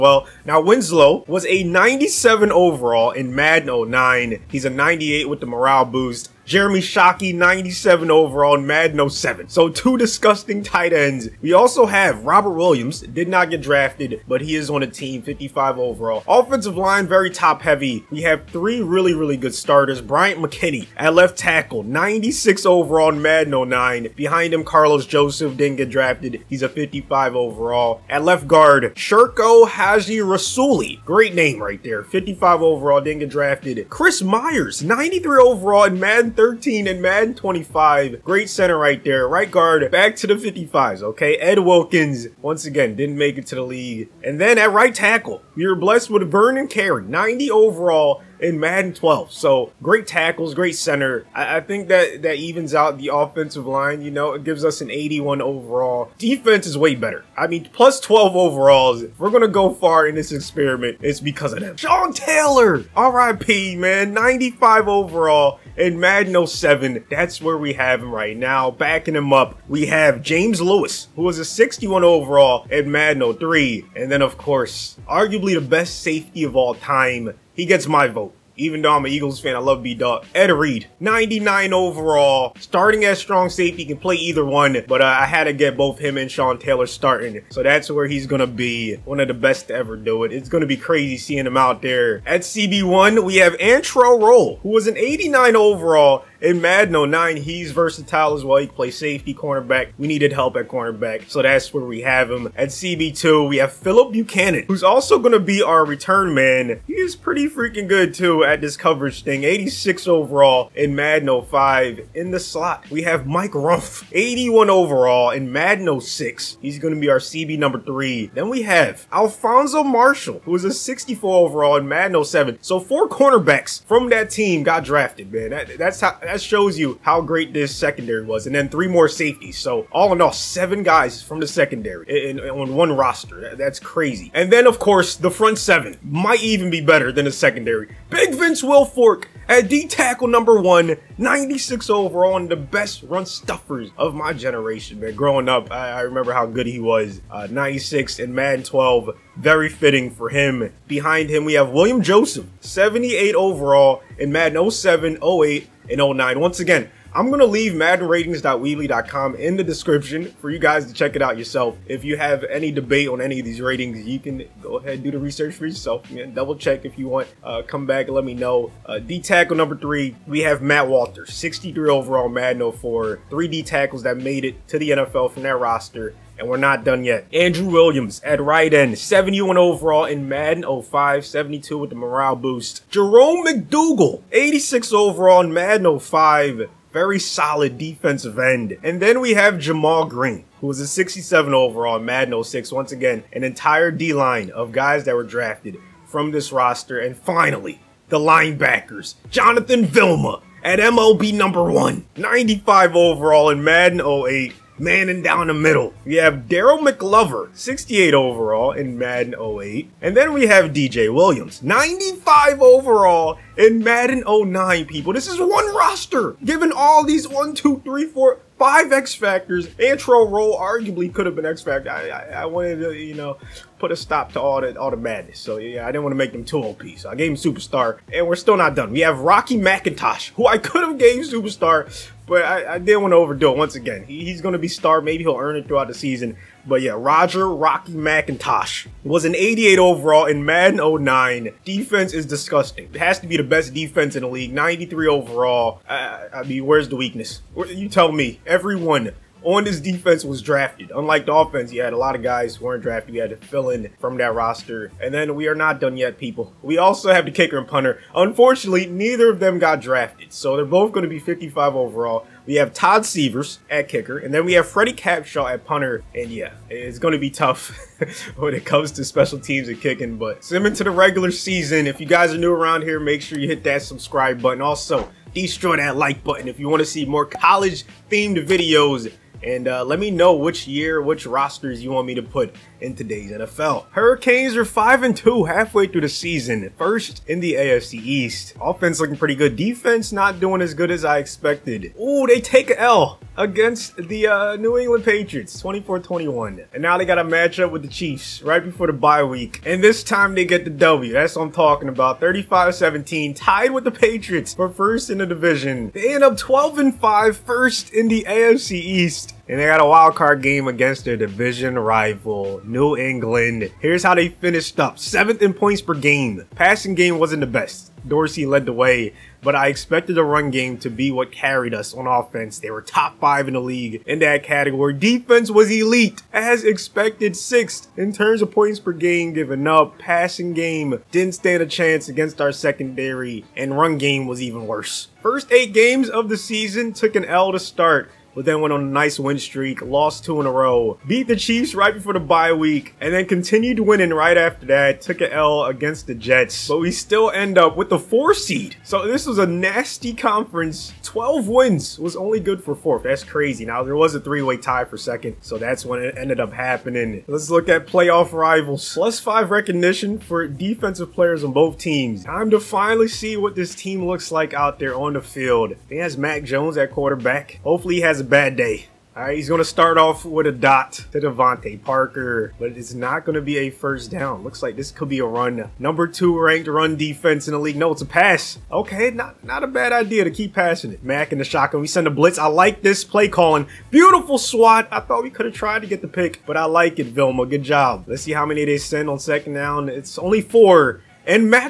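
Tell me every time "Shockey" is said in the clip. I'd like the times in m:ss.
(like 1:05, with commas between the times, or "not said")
0:06.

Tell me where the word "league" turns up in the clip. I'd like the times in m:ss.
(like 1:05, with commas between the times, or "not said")
0:43, 4:04, 5:23, 6:17.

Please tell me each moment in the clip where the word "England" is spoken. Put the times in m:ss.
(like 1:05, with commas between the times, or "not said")
4:54, 5:12.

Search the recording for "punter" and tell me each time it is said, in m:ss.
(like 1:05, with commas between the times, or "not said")
4:17, 4:25.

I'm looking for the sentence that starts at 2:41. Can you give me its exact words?
If you have any debate on any of these ratings, you can go ahead do the research for yourself.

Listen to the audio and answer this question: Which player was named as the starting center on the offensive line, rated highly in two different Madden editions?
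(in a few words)
Chris Myers.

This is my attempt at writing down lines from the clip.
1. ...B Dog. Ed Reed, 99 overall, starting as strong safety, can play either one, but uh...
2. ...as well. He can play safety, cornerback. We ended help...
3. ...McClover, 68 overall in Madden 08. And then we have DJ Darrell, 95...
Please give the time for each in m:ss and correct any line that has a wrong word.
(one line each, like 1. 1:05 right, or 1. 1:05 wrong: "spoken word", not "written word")
1. 1:19 right
2. 1:38 wrong: "needed", not "ended"
3. 3:26 wrong: "Williams", not "Darrell".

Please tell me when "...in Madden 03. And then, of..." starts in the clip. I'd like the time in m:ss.
1:12.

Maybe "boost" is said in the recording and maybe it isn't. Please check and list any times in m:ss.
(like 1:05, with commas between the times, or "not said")
0:05, 3:02.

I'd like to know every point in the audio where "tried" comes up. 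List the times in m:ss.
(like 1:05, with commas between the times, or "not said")
6:25.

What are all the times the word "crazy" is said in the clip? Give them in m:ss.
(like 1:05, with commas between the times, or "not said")
1:30, 2:13, 5:53.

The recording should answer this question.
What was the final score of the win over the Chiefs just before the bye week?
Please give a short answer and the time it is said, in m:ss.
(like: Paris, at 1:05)
35-17, at 5:02.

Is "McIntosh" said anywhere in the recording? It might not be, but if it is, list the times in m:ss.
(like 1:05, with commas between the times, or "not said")
3:49, 3:57.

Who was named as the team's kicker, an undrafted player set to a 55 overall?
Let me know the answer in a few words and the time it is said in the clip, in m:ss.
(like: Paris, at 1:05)
Todd Sievers, at 4:22.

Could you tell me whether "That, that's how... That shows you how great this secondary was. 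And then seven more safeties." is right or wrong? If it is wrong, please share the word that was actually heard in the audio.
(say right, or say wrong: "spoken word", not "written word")
wrong: "three", not "seven".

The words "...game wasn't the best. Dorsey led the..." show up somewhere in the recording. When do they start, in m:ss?
5:16.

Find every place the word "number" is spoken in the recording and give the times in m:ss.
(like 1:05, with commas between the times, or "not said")
1:57, 2:20, 2:49, 3:21, 6:15.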